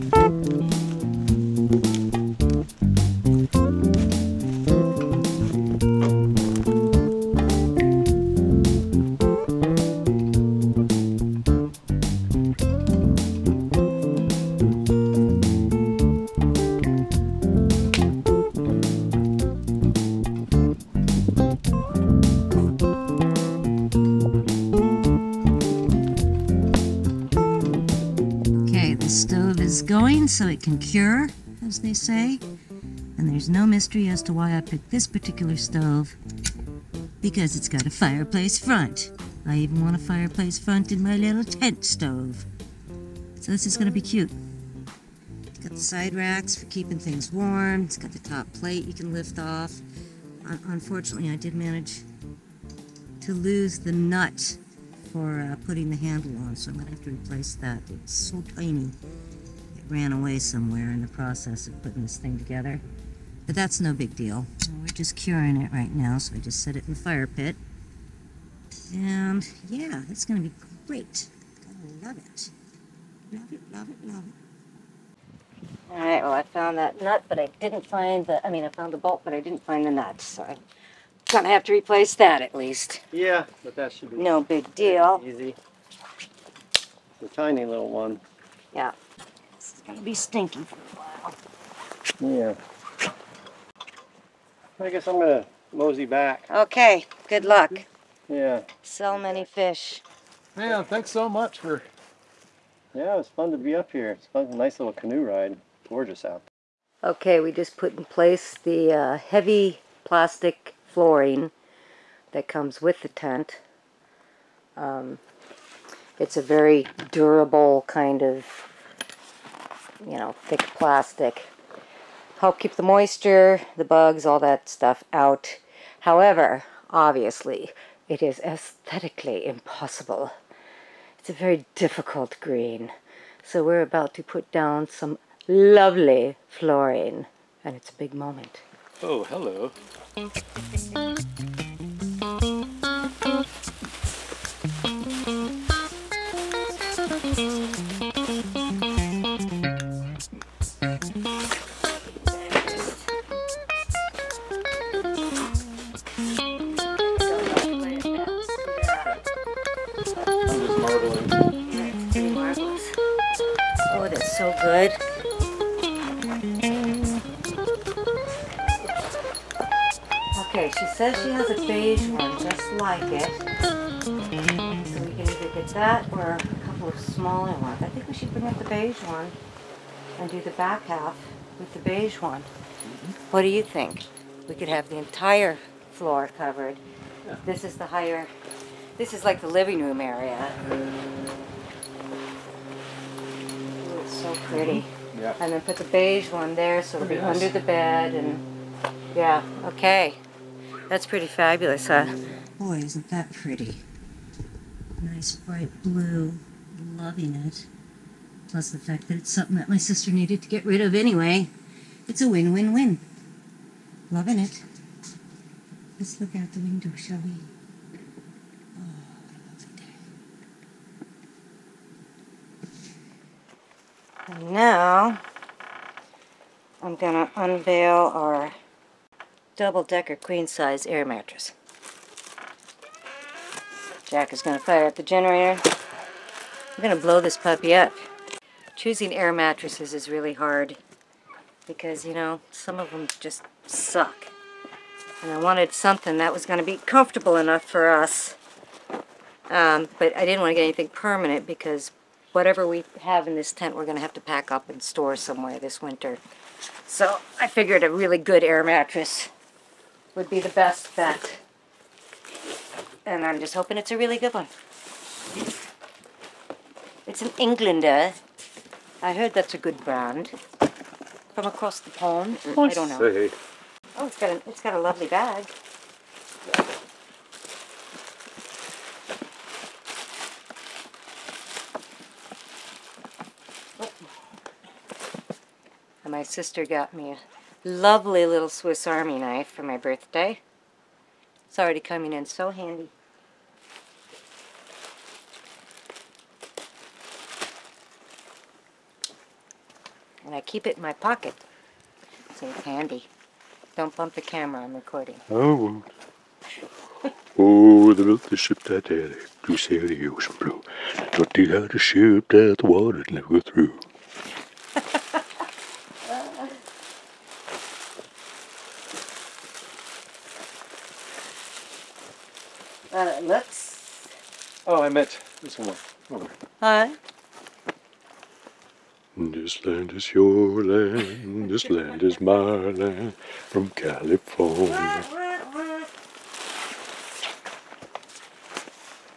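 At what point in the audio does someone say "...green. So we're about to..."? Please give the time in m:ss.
2:12.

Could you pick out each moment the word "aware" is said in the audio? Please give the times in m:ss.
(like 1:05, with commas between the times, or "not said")
not said.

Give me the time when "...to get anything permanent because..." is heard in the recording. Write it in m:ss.
4:10.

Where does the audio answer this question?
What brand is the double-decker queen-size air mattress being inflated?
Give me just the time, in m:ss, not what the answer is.
4:27.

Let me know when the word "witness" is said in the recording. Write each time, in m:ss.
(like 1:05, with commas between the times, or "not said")
not said.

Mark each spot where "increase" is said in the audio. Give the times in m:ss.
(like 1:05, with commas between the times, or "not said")
not said.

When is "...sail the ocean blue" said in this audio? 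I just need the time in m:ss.
5:09.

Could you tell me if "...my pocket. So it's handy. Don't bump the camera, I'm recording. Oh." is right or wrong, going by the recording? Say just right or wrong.
right.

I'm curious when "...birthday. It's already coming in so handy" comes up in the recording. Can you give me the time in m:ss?
4:49.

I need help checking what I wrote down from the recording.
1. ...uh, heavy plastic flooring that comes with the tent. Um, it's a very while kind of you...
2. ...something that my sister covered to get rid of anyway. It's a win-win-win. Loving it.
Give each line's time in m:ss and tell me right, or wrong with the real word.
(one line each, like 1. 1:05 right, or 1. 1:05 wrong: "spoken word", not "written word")
1. 1:48 wrong: "durable", not "while"
2. 3:29 wrong: "needed", not "covered".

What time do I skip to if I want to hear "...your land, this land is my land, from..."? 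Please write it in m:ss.
5:30.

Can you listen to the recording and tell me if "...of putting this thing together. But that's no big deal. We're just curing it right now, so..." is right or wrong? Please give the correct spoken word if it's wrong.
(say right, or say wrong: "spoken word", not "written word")
right.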